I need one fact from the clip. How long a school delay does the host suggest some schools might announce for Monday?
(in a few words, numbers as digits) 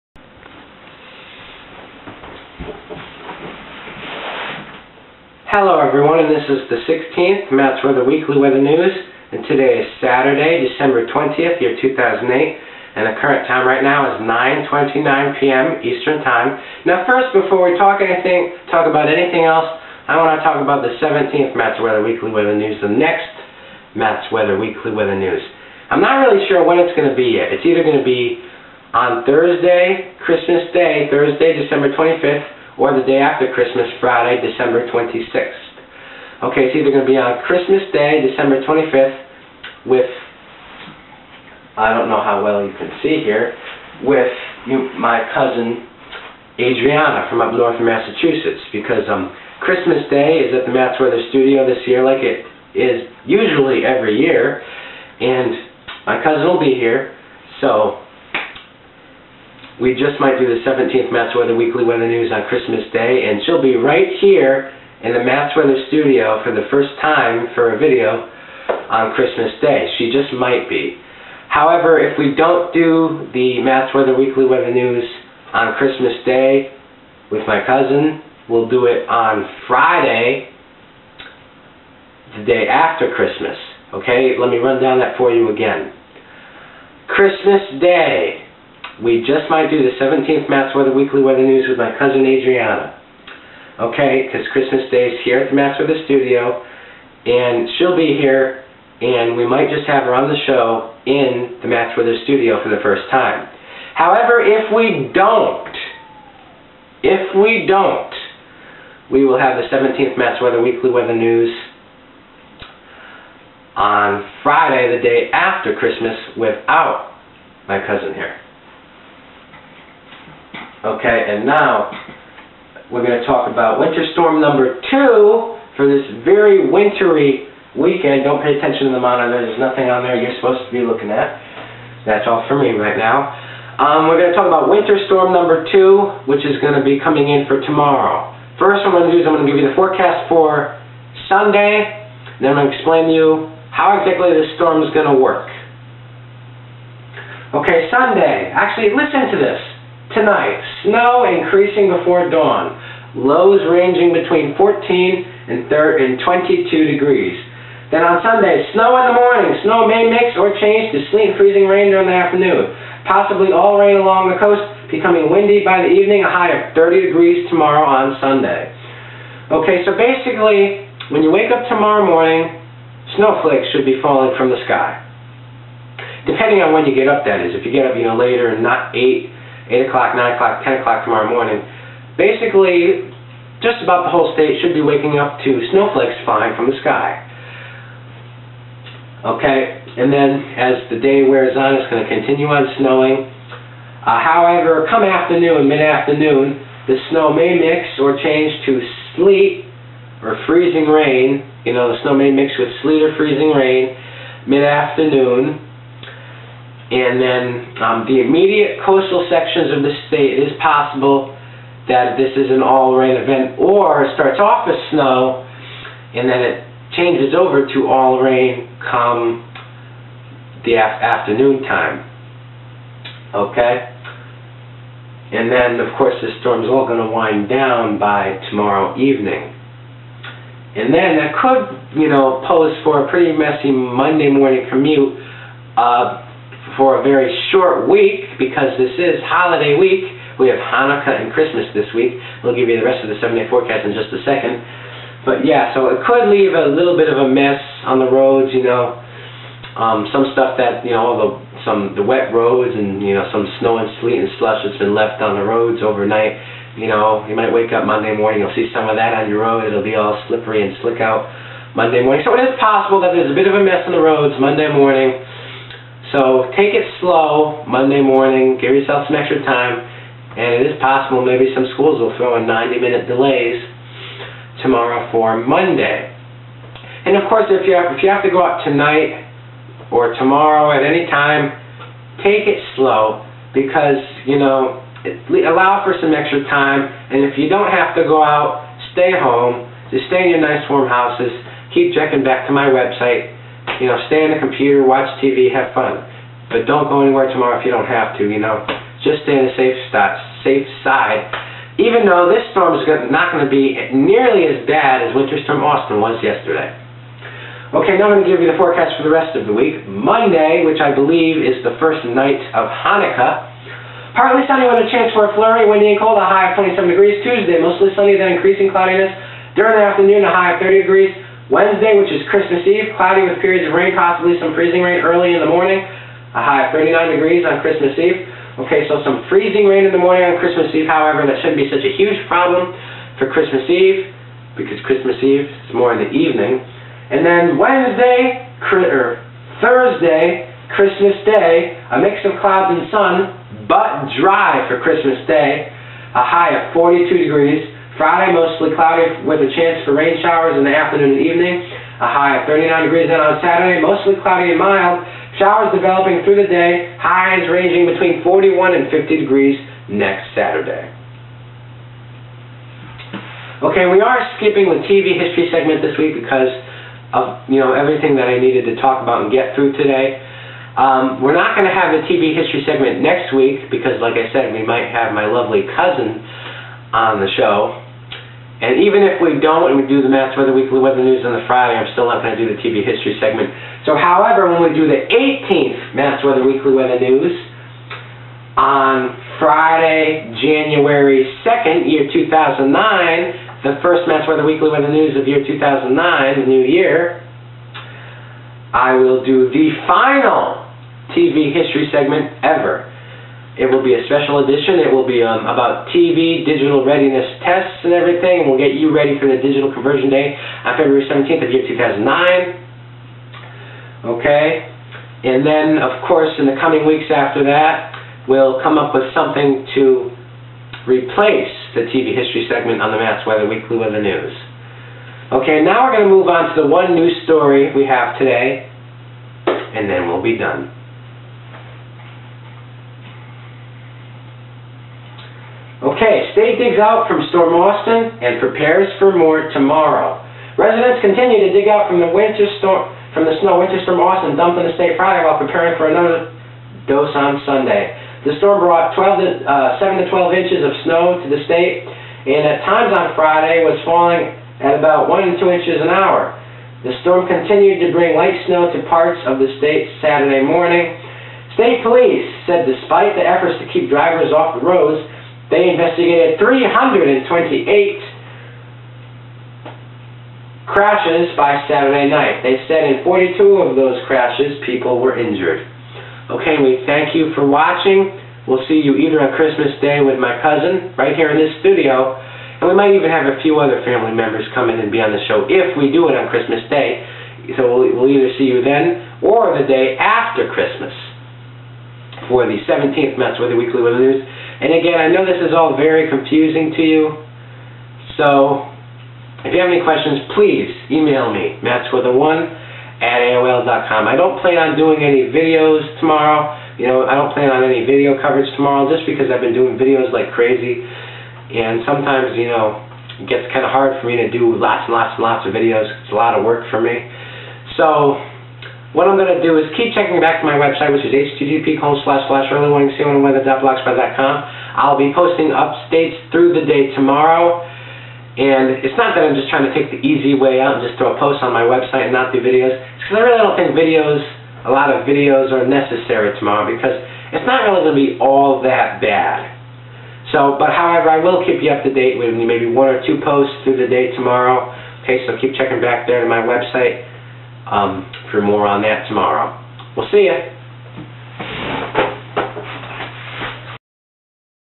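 90 minutes.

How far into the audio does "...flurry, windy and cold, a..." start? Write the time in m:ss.
5:15.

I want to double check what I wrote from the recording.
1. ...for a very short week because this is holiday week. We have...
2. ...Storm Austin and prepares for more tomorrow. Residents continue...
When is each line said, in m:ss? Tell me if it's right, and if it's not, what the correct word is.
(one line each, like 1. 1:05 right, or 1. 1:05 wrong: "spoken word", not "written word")
1. 3:56 right
2. 7:17 right.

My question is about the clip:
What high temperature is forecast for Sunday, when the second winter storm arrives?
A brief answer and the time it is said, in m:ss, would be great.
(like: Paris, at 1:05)
30 degrees, at 2:46.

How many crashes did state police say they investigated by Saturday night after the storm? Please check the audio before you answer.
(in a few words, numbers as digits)
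328.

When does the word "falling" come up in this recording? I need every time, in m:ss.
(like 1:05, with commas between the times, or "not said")
2:54, 7:33.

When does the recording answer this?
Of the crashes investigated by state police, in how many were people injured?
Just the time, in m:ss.
7:53.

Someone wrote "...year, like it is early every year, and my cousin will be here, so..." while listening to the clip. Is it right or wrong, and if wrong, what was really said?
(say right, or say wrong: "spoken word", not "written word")
wrong: "usually", not "early".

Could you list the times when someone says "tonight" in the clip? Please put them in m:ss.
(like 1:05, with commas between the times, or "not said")
2:30, 4:38.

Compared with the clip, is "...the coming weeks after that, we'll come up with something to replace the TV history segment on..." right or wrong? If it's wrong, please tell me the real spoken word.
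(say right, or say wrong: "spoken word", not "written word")
right.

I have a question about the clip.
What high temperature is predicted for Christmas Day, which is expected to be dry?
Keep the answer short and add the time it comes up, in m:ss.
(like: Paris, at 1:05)
42 degrees, at 5:46.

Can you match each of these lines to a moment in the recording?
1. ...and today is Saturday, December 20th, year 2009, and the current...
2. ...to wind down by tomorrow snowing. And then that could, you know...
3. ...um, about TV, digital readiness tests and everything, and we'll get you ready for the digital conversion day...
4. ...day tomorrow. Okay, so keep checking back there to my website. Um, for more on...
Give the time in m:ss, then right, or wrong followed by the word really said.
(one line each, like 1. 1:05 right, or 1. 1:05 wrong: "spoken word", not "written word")
1. 0:09 wrong: "2008", not "2009"
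2. 3:46 wrong: "evening", not "snowing"
3. 6:45 right
4. 9:03 right.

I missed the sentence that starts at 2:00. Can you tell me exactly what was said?
Okay, and now we're going to talk about winter storm number two for this very wintry weekend.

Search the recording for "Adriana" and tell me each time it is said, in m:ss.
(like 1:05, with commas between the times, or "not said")
0:46, 1:32.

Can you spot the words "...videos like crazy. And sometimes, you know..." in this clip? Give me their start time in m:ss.
8:29.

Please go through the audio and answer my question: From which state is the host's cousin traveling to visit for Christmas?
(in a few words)
Massachusetts.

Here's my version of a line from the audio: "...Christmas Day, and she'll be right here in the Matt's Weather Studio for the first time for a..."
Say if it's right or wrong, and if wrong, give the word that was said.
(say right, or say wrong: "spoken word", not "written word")
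right.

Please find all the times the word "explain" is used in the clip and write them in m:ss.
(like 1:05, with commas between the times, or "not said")
2:22.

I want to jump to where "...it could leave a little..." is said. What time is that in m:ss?
4:05.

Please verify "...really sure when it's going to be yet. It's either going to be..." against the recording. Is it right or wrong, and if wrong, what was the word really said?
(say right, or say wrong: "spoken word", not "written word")
right.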